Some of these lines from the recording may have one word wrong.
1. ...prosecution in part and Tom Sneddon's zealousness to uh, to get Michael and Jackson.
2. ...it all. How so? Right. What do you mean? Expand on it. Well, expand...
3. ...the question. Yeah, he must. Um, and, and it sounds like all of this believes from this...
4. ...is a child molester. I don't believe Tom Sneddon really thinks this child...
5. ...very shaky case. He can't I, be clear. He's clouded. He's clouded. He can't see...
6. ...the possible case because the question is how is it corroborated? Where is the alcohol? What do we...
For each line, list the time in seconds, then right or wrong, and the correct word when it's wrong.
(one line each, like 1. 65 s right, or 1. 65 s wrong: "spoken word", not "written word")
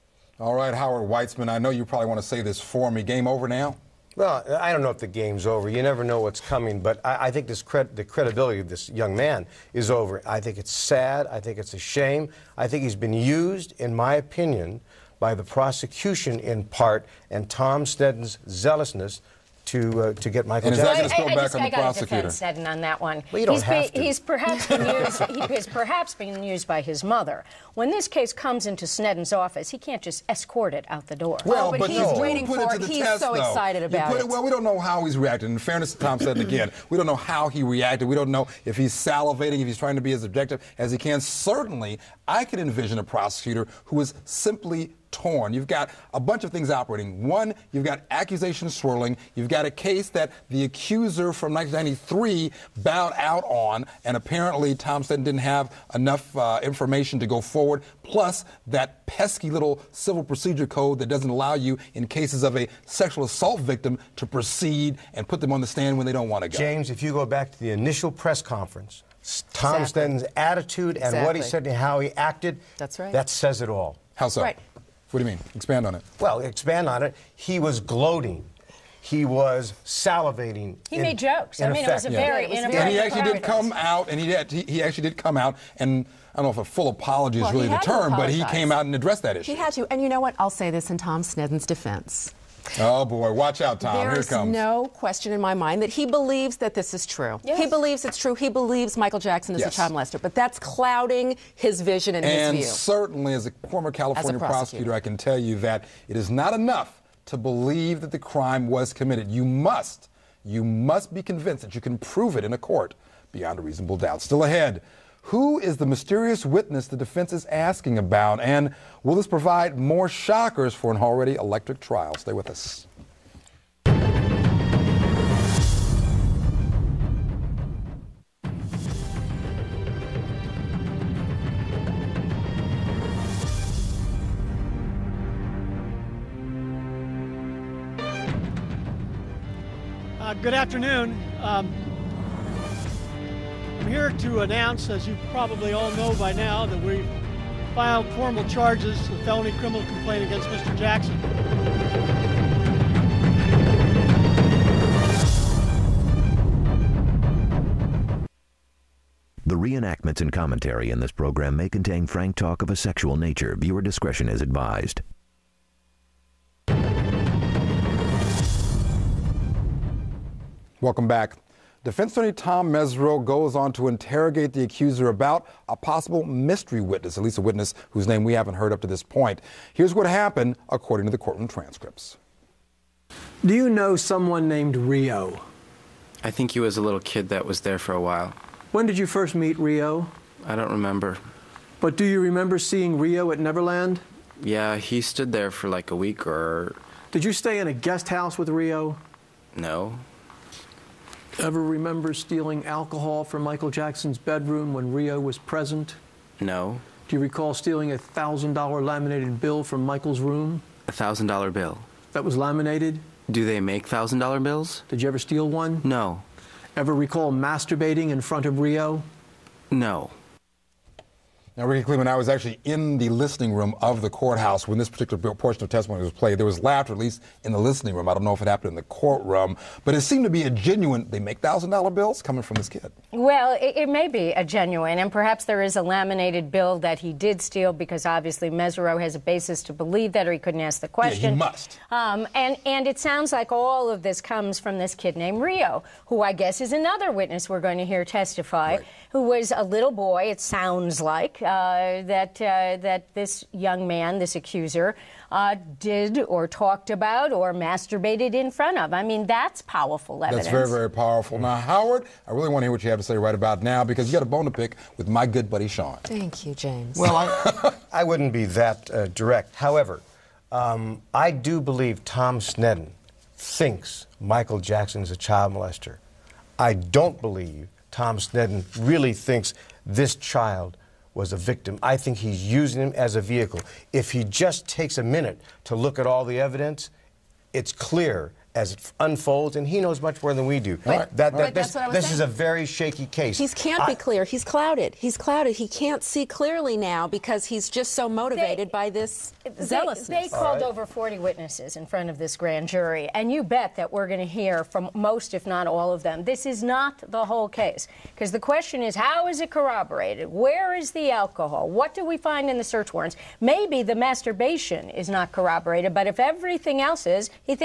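1. 15 s right
2. 73 s right
3. 240 s wrong: "comes", not "believes"
4. 275 s right
5. 292 s right
6. 307 s wrong: "whole", not "possible".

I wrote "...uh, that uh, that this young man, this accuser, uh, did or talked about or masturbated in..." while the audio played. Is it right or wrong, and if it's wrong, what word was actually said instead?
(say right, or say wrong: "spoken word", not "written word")
right.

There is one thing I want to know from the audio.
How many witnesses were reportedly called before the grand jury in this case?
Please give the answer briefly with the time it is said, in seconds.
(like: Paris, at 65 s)
over 40, at 300 s.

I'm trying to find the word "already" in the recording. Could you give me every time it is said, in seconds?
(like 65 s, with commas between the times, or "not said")
121 s.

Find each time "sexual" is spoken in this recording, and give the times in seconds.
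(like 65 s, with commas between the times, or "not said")
62 s, 162 s.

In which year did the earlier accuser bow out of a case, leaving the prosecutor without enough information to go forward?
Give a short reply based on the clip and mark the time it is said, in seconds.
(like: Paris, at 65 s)
1993, at 51 s.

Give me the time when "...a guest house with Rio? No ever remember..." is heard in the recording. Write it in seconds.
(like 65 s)
197 s.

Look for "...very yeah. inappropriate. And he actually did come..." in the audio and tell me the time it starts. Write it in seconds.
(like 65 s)
82 s.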